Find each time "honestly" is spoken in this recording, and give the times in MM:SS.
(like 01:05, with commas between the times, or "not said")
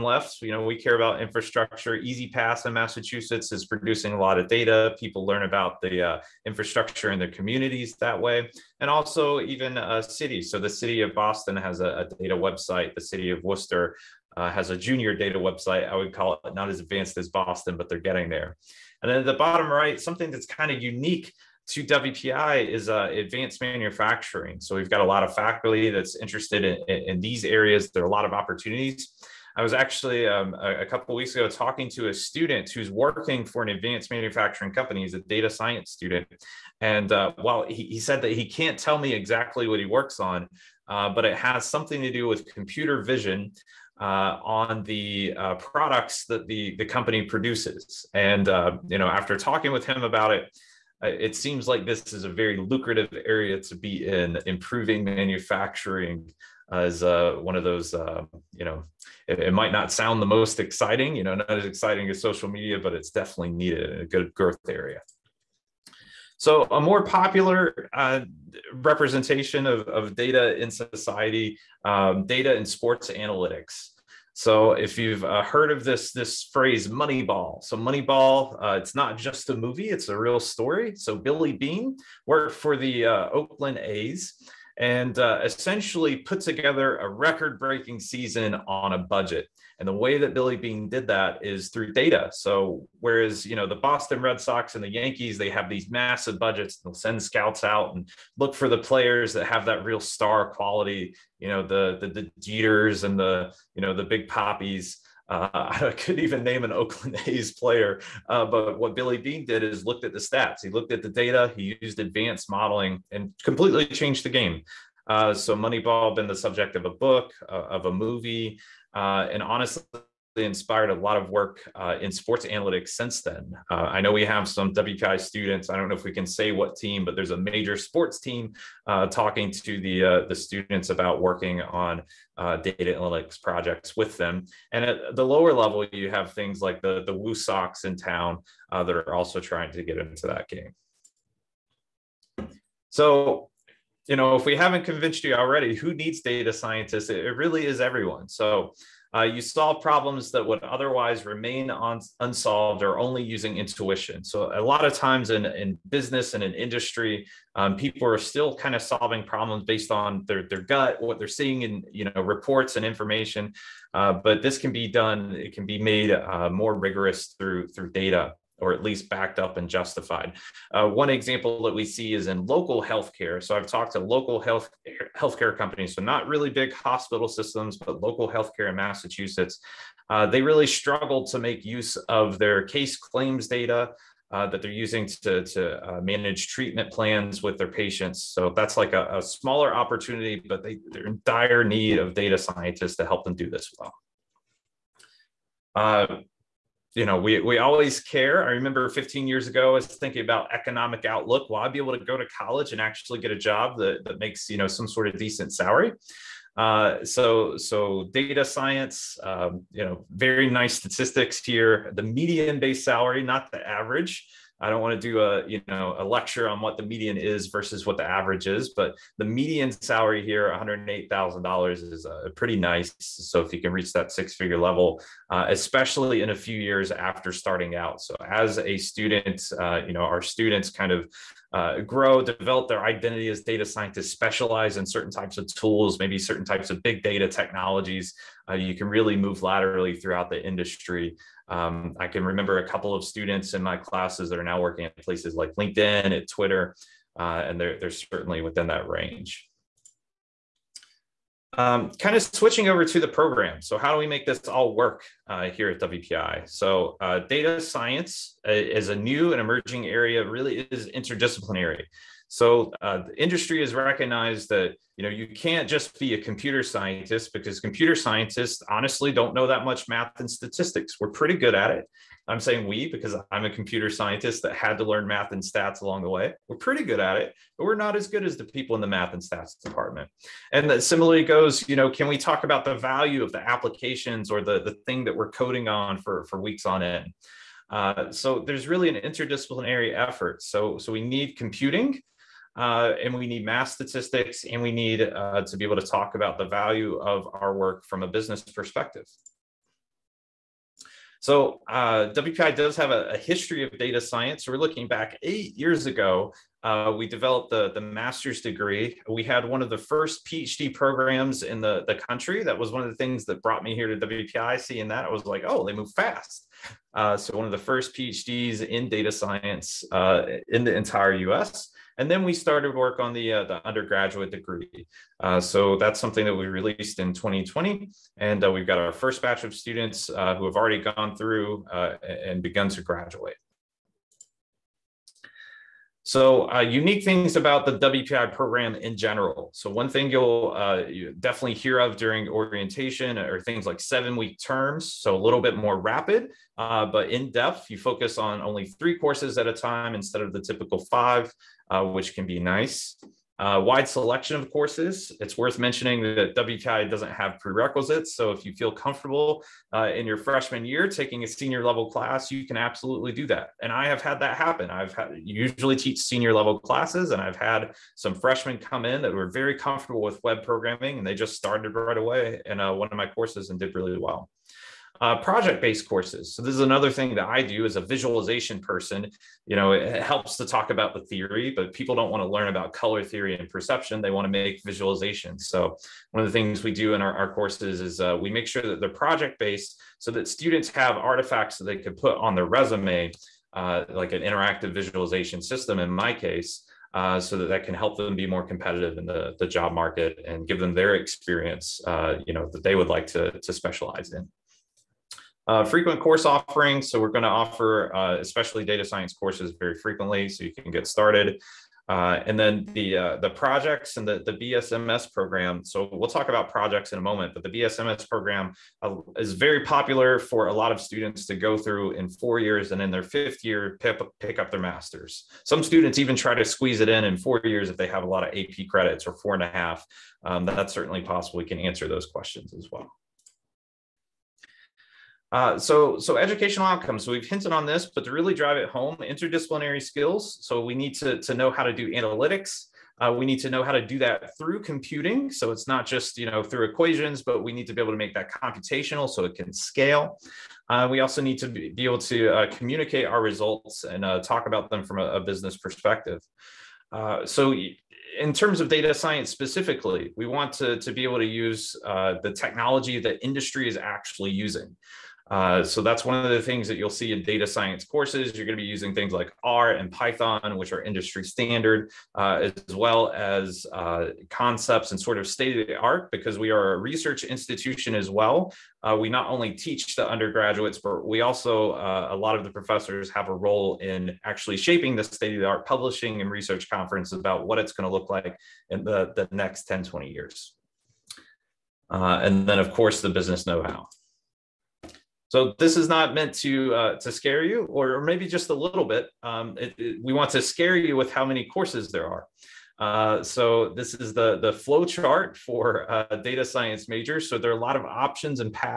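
01:59, 04:28.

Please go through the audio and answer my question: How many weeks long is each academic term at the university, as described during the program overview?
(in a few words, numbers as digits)
7.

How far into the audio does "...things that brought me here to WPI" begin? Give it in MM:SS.
05:12.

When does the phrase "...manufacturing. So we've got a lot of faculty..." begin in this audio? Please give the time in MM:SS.
00:23.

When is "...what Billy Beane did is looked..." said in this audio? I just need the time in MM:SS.
01:48.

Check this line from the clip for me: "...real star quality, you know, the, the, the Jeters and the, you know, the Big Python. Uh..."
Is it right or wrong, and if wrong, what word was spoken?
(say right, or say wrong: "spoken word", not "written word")
wrong: "Papis", not "Python".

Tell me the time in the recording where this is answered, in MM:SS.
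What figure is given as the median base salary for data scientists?
03:40.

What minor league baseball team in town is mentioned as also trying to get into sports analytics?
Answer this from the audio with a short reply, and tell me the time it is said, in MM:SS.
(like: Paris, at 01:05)
Woo Sox, at 02:17.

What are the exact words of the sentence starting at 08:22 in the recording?
Uh, so this is the the flow chart for uh, data science majors.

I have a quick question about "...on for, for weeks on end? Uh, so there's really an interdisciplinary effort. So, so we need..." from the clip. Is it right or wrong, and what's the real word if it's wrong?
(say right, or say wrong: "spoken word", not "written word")
right.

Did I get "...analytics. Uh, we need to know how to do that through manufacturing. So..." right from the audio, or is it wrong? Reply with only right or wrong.
wrong.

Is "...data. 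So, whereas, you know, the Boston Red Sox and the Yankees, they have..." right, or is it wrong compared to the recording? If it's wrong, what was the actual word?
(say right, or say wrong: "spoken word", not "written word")
right.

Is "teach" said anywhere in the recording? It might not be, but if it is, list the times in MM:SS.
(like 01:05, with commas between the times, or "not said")
06:05, 07:59.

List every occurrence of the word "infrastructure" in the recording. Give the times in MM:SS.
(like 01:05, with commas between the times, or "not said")
00:01, 00:06.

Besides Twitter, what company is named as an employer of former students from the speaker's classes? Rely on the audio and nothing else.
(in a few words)
LinkedIn.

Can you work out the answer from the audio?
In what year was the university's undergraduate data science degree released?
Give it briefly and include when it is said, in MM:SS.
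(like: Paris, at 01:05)
2020, at 05:27.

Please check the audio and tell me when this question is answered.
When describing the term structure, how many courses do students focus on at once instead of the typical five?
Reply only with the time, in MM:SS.
05:48.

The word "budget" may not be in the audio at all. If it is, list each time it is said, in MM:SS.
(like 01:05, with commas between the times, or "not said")
01:28, 01:36.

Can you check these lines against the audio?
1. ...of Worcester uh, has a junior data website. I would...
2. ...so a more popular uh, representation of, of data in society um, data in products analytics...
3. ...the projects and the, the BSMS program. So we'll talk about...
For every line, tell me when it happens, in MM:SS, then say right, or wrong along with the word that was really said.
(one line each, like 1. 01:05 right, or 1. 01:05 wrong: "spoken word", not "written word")
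1. 00:13 right
2. 01:06 wrong: "sports", not "products"
3. 06:53 right.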